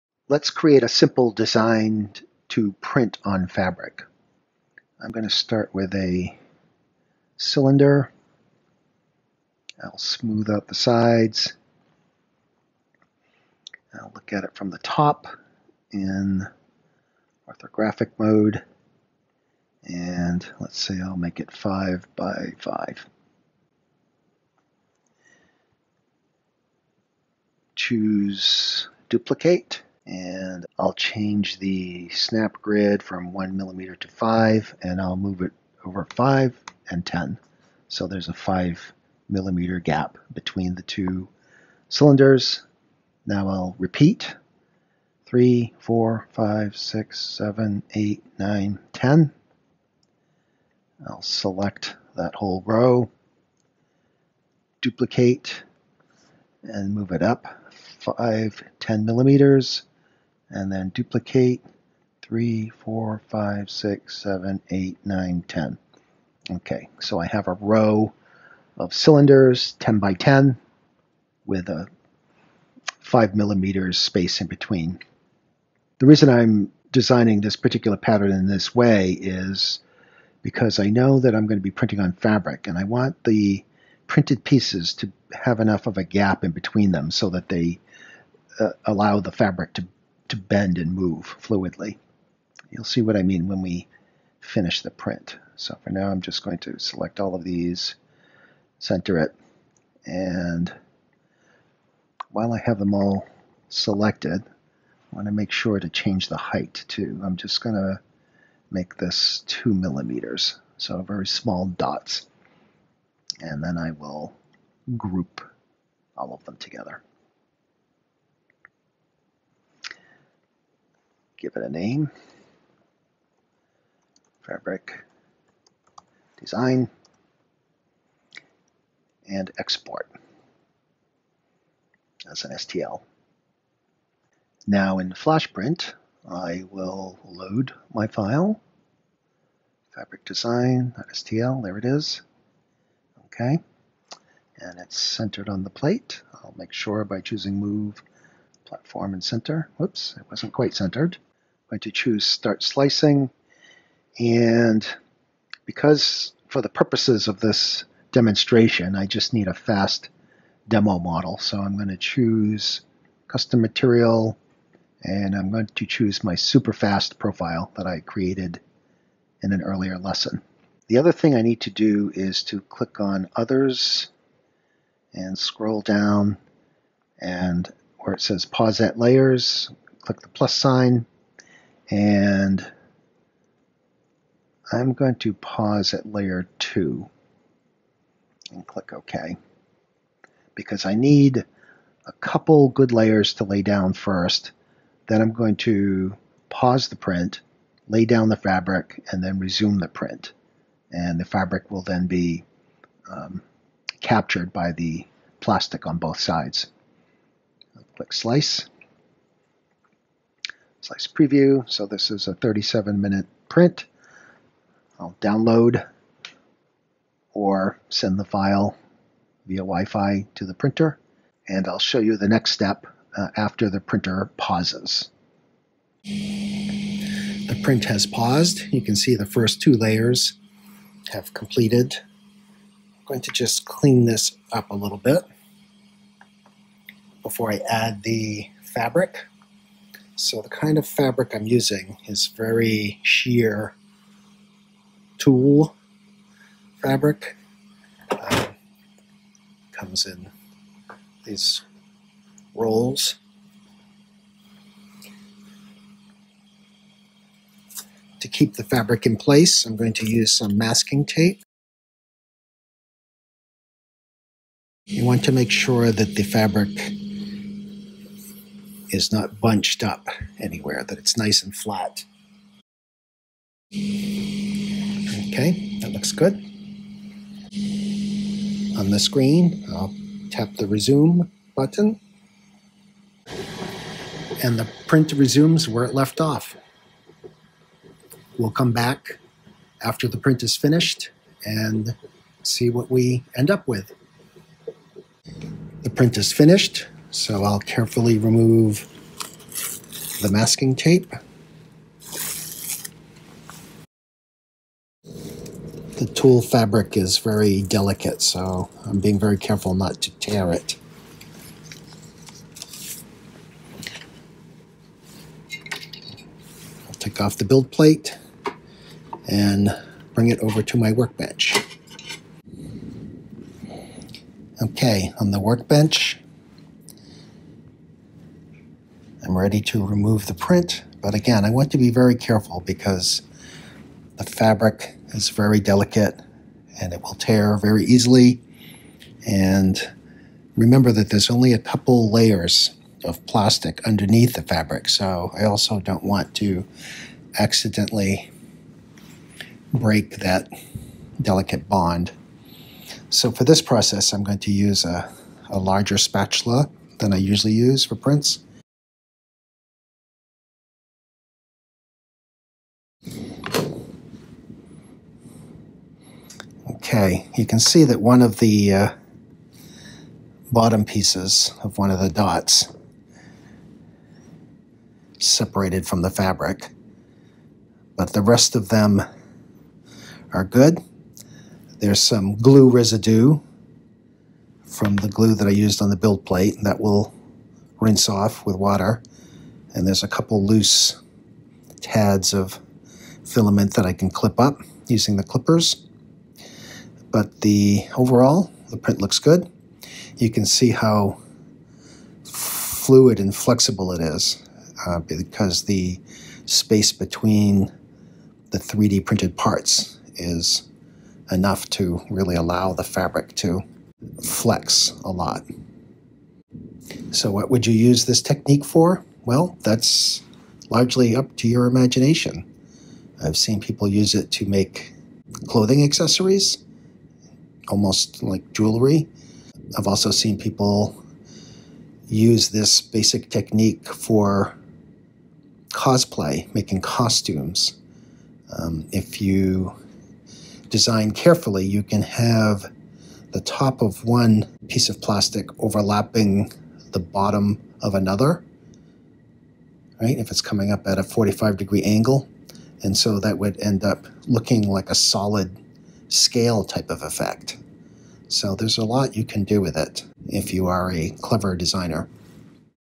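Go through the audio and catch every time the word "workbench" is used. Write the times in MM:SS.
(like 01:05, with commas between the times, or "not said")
05:20, 05:25.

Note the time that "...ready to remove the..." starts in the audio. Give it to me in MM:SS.
05:29.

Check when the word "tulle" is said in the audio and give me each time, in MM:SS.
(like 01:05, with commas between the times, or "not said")
04:05, 05:06.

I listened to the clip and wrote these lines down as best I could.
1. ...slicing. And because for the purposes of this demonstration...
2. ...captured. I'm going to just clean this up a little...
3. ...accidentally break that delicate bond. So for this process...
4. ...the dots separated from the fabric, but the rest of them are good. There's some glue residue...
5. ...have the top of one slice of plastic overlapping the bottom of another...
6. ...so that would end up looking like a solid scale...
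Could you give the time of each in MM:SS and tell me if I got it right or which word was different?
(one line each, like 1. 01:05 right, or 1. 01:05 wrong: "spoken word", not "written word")
1. 02:32 right
2. 03:51 wrong: "completed", not "captured"
3. 05:47 right
4. 06:12 right
5. 07:22 wrong: "piece", not "slice"
6. 07:32 right.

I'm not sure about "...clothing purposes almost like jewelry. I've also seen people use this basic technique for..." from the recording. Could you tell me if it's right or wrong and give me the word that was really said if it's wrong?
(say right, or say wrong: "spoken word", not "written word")
wrong: "accessories", not "purposes".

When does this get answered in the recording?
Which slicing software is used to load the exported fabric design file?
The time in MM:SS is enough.
02:15.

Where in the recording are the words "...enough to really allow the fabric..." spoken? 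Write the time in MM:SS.
06:51.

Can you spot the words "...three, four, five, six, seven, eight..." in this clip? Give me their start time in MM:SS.
00:45.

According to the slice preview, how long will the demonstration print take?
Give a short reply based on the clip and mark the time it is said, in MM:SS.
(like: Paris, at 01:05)
37 minutes, at 03:32.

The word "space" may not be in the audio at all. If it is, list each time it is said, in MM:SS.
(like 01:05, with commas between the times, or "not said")
01:13, 06:46.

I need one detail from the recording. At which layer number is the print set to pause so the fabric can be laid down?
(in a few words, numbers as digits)
2.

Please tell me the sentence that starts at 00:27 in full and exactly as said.
Choose duplicate and I'll change the snap grid from one millimeter to five and I'll move it over five and 10.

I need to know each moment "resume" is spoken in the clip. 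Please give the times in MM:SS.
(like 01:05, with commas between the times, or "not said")
03:19, 04:40, 04:45.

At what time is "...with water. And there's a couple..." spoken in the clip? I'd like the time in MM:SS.
06:28.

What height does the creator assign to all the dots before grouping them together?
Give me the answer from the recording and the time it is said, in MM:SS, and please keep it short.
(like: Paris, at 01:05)
2 millimeters, at 01:49.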